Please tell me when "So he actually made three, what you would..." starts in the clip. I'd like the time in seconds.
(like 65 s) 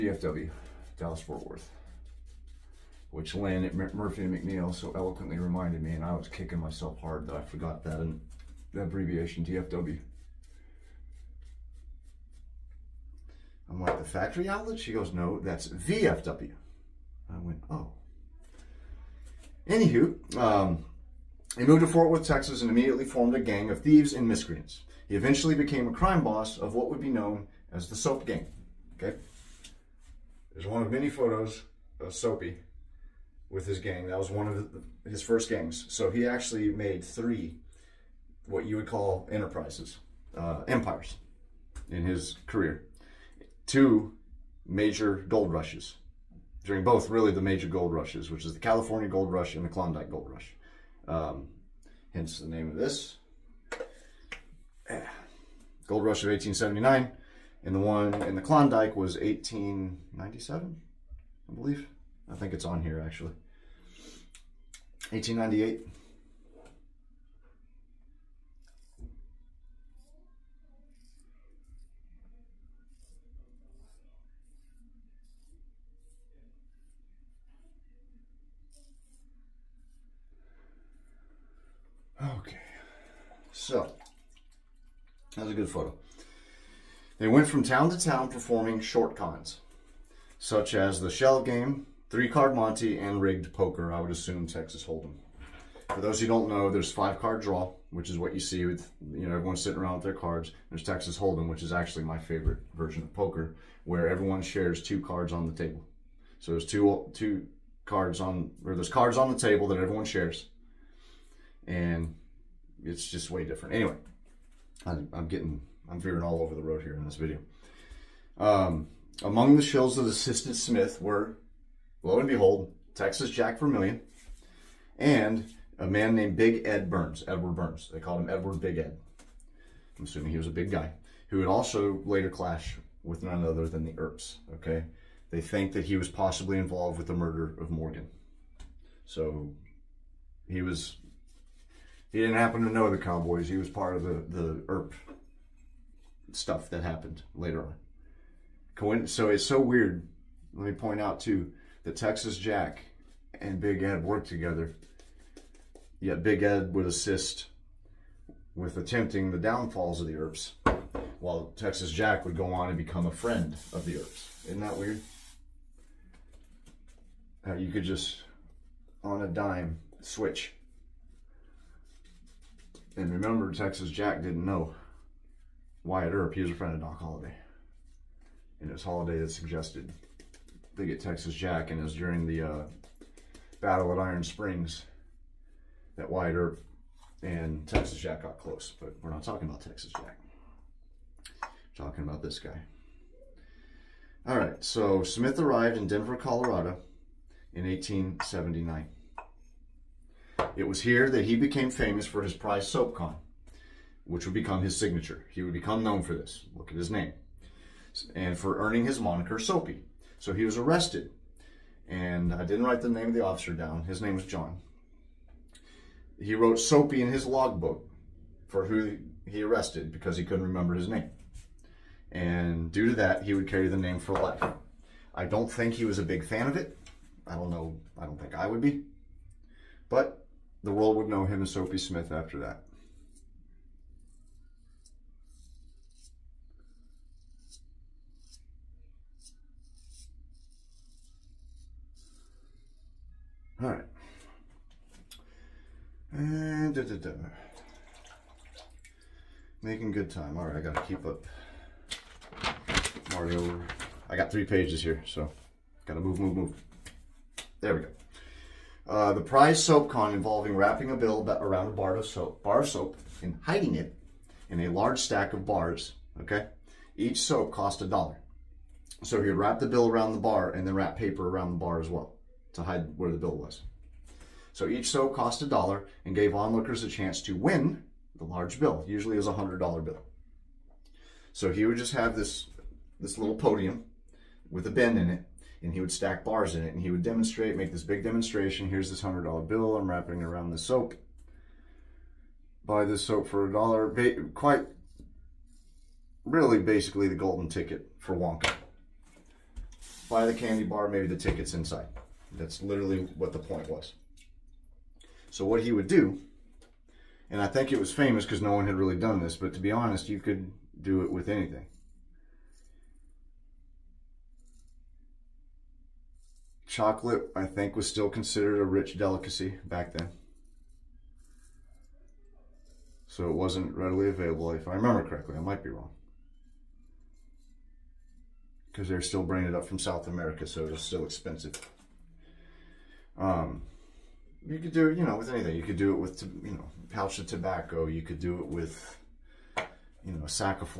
35 s.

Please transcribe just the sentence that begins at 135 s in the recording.
They think that he was possibly involved with the murder of Morgan.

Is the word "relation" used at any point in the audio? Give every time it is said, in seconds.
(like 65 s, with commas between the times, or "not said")
not said.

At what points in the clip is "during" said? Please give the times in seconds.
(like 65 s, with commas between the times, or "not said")
46 s, 181 s.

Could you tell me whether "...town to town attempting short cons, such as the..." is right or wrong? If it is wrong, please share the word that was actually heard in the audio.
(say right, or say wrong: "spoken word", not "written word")
wrong: "performing", not "attempting".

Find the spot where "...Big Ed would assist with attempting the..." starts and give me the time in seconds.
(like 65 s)
156 s.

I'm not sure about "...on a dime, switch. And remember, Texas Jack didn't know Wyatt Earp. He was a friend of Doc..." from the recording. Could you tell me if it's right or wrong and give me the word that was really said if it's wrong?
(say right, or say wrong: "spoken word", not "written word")
right.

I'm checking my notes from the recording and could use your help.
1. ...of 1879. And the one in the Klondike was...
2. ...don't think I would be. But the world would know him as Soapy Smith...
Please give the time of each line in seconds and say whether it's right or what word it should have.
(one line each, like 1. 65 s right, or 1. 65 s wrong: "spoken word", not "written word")
1. 56 s right
2. 228 s right.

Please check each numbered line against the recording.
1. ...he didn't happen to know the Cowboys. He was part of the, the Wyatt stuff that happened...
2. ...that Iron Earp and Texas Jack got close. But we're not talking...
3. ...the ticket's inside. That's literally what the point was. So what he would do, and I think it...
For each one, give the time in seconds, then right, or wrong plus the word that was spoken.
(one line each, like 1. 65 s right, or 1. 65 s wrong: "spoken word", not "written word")
1. 142 s wrong: "Earp", not "Wyatt"
2. 185 s wrong: "Wyatt", not "Iron"
3. 301 s right.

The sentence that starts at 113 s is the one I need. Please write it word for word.
Anyway, I'm, I'm getting, I'm veering all over the road here in this video.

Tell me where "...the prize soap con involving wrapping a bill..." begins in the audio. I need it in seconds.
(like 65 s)
259 s.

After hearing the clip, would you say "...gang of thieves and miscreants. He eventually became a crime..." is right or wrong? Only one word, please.
right.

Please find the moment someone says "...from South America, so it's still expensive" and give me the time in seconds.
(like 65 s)
329 s.